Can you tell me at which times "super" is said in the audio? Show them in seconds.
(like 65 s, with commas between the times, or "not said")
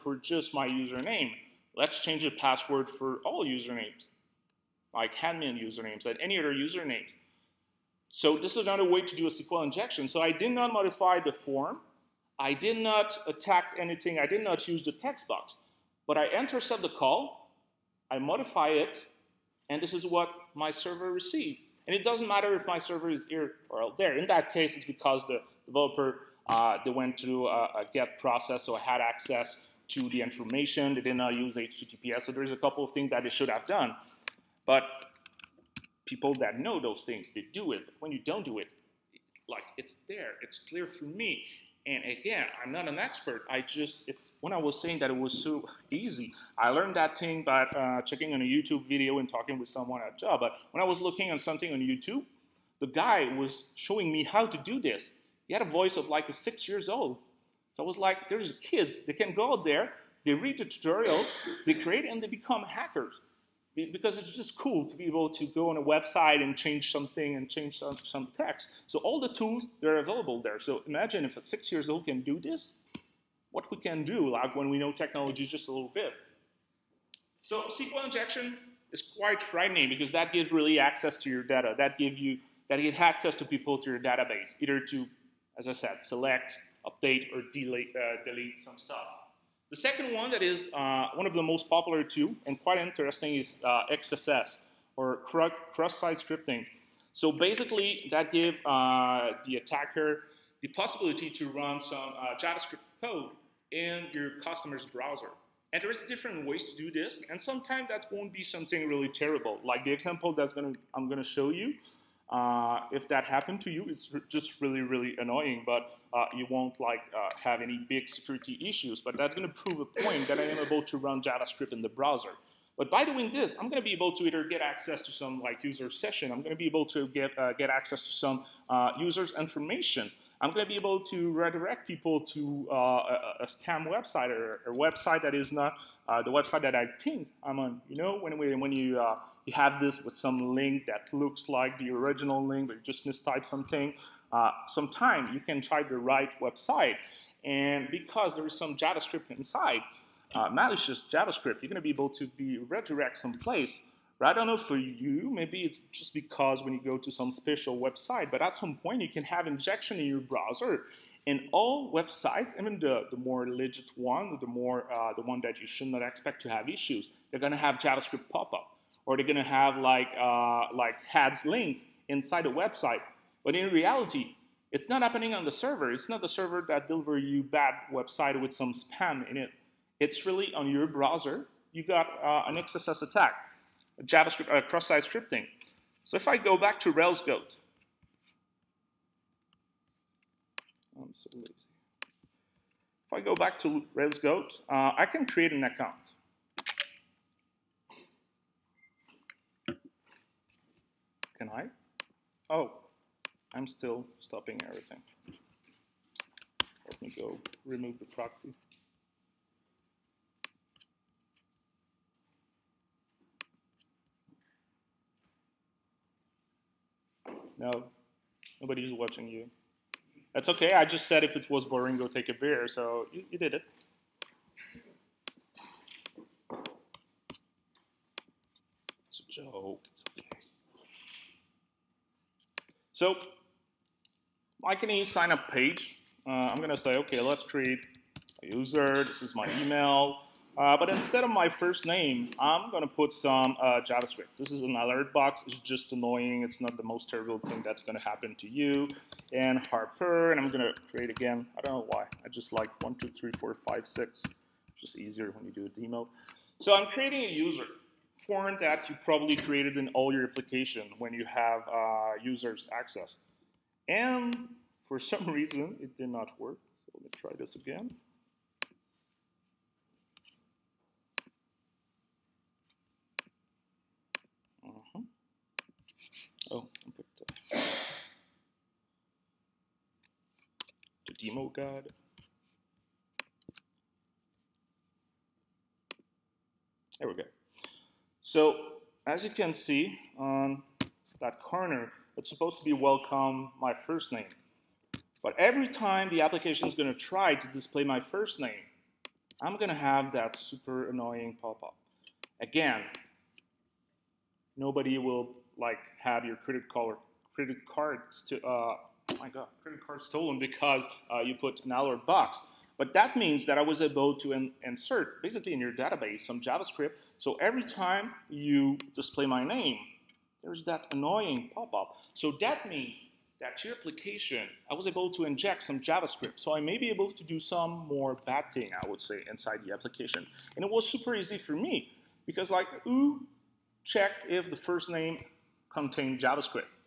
300 s, 330 s.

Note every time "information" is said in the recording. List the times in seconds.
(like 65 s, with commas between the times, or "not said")
30 s, 129 s.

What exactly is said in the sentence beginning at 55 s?
He had a voice of like a six years old.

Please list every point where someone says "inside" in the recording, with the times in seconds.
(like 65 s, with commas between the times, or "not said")
149 s, 172 s, 329 s.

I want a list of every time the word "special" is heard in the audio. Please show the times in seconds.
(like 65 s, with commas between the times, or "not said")
157 s.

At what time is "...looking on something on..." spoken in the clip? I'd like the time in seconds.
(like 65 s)
51 s.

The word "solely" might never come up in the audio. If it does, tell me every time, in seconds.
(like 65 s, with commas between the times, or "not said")
not said.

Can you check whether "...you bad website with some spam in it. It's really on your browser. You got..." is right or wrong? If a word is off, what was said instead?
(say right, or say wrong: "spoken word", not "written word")
right.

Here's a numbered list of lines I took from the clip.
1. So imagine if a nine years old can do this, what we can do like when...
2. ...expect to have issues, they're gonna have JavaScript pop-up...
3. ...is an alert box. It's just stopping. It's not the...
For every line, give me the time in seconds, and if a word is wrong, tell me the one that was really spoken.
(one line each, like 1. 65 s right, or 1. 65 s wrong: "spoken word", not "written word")
1. 70 s wrong: "six", not "nine"
2. 166 s right
3. 244 s wrong: "annoying", not "stopping".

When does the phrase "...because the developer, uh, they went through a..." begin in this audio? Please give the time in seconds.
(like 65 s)
24 s.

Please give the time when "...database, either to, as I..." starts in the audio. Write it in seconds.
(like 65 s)
83 s.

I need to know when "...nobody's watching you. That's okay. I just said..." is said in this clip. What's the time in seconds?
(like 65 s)
218 s.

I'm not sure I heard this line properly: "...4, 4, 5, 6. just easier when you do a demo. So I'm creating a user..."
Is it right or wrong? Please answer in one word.
wrong.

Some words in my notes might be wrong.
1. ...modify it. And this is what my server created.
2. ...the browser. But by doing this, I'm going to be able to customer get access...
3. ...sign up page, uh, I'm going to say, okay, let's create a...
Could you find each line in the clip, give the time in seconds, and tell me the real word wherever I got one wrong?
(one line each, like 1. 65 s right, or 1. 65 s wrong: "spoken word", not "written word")
1. 18 s wrong: "received", not "created"
2. 121 s wrong: "either", not "customer"
3. 235 s right.